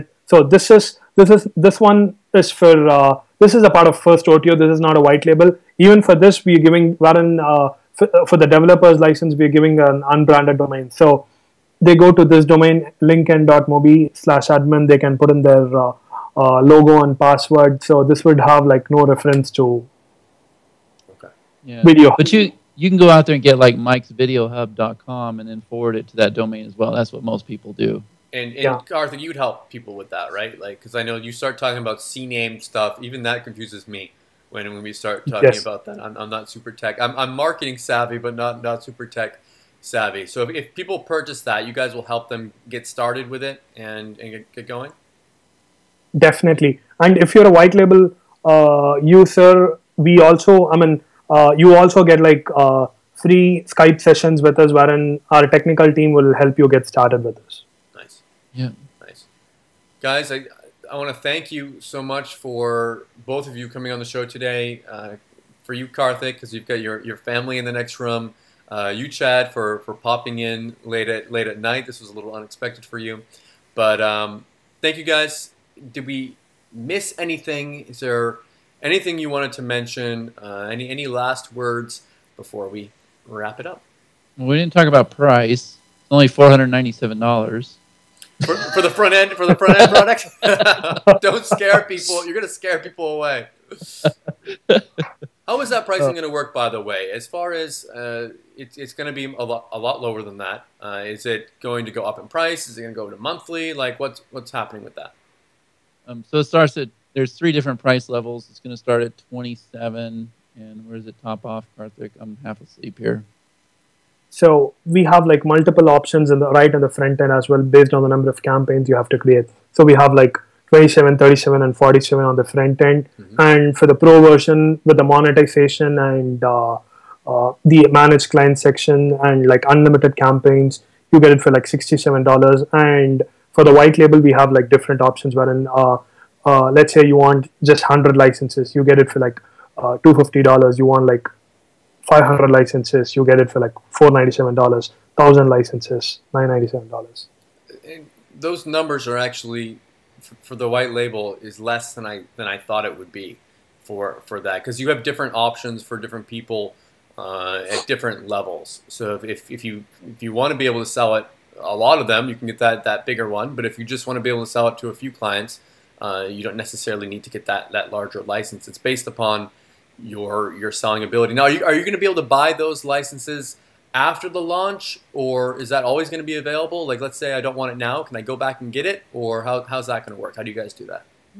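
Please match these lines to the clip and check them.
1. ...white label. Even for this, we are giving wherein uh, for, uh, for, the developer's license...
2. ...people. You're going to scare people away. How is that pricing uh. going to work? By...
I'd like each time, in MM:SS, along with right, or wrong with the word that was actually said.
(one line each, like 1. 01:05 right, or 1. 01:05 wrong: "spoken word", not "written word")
1. 00:04 right
2. 01:31 right.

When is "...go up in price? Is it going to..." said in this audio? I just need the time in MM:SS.
01:41.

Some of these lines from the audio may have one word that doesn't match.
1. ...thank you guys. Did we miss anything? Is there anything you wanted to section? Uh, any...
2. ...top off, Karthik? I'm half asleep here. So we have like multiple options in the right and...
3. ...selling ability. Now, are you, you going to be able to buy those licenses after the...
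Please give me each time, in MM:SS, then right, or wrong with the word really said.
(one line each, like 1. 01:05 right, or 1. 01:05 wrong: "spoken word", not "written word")
1. 01:14 wrong: "mention", not "section"
2. 01:51 right
3. 02:50 right.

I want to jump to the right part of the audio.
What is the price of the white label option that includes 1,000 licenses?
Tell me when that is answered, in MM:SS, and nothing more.
02:26.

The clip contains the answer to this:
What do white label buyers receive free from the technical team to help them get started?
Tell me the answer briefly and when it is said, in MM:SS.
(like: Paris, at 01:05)
Skype sessions, at 00:53.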